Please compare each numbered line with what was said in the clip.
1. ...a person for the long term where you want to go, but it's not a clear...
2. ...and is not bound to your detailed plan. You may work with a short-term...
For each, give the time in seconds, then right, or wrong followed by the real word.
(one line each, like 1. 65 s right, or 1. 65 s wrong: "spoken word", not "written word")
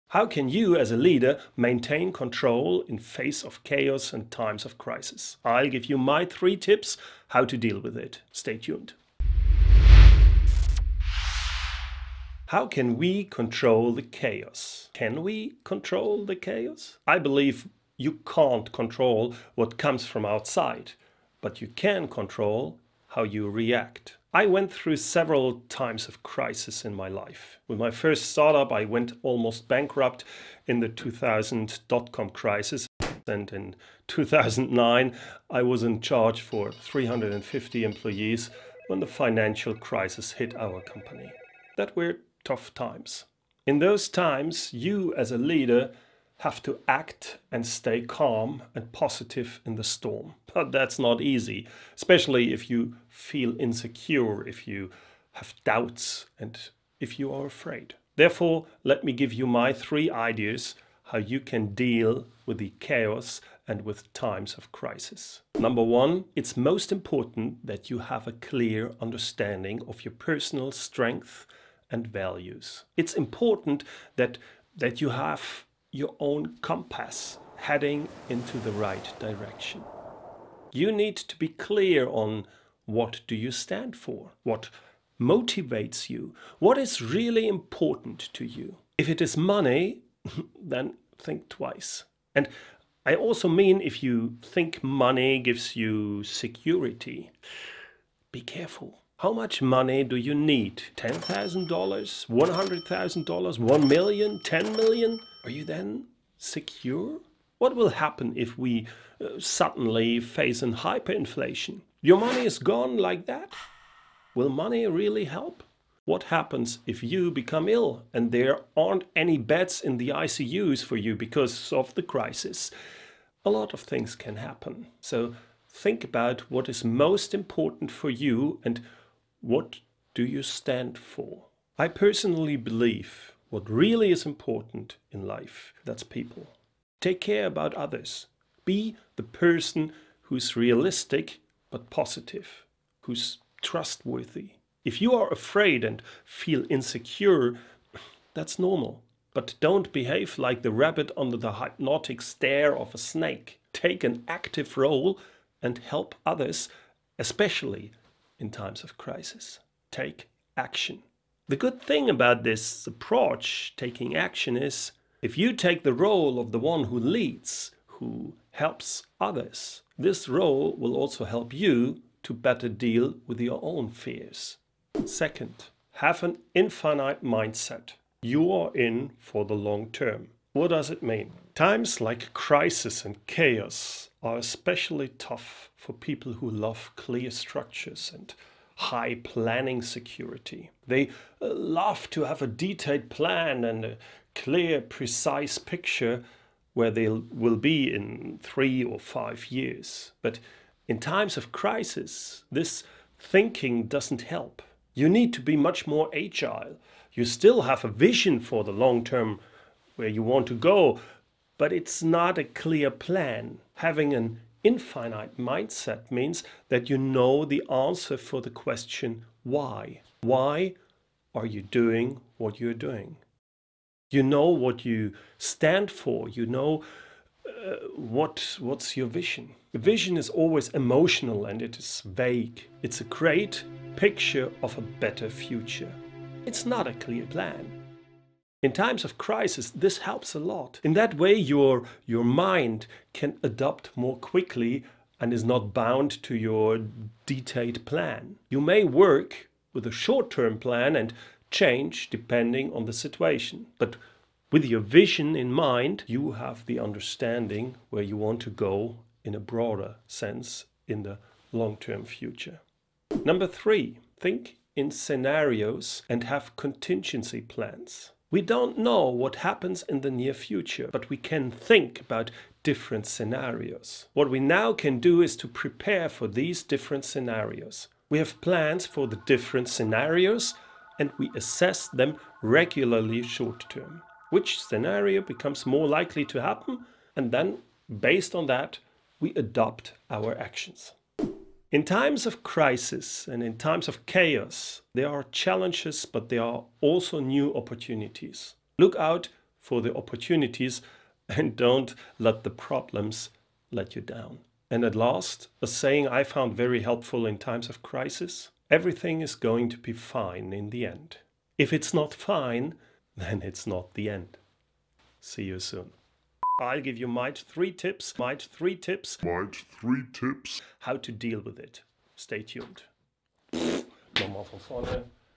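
1. 207 s wrong: "vision", not "person"
2. 245 s right.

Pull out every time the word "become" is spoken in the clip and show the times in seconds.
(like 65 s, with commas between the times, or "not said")
117 s, 285 s.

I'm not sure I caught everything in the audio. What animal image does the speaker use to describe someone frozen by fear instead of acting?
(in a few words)
rabbit.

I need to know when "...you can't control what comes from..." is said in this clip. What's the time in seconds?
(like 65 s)
17 s.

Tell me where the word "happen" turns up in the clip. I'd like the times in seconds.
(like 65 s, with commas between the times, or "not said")
107 s, 116 s, 124 s, 269 s, 286 s.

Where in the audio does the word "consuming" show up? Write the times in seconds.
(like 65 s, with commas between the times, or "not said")
not said.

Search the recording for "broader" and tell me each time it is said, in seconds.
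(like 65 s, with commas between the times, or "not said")
259 s.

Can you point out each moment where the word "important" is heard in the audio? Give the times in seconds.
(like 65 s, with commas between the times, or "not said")
66 s, 73 s, 87 s, 127 s, 134 s.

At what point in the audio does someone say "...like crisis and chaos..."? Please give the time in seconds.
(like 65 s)
182 s.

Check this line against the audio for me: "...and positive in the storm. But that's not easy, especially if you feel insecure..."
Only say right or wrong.
right.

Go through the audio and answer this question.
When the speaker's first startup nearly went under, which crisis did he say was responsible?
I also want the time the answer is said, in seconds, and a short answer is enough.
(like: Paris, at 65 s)
2000 dot com crisis, at 30 s.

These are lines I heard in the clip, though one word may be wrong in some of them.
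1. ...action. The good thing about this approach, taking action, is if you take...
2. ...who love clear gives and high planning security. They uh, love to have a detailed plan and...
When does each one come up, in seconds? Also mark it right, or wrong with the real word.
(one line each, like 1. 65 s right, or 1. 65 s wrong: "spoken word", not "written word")
1. 160 s right
2. 186 s wrong: "structures", not "gives".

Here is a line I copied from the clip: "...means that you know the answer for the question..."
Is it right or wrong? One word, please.
right.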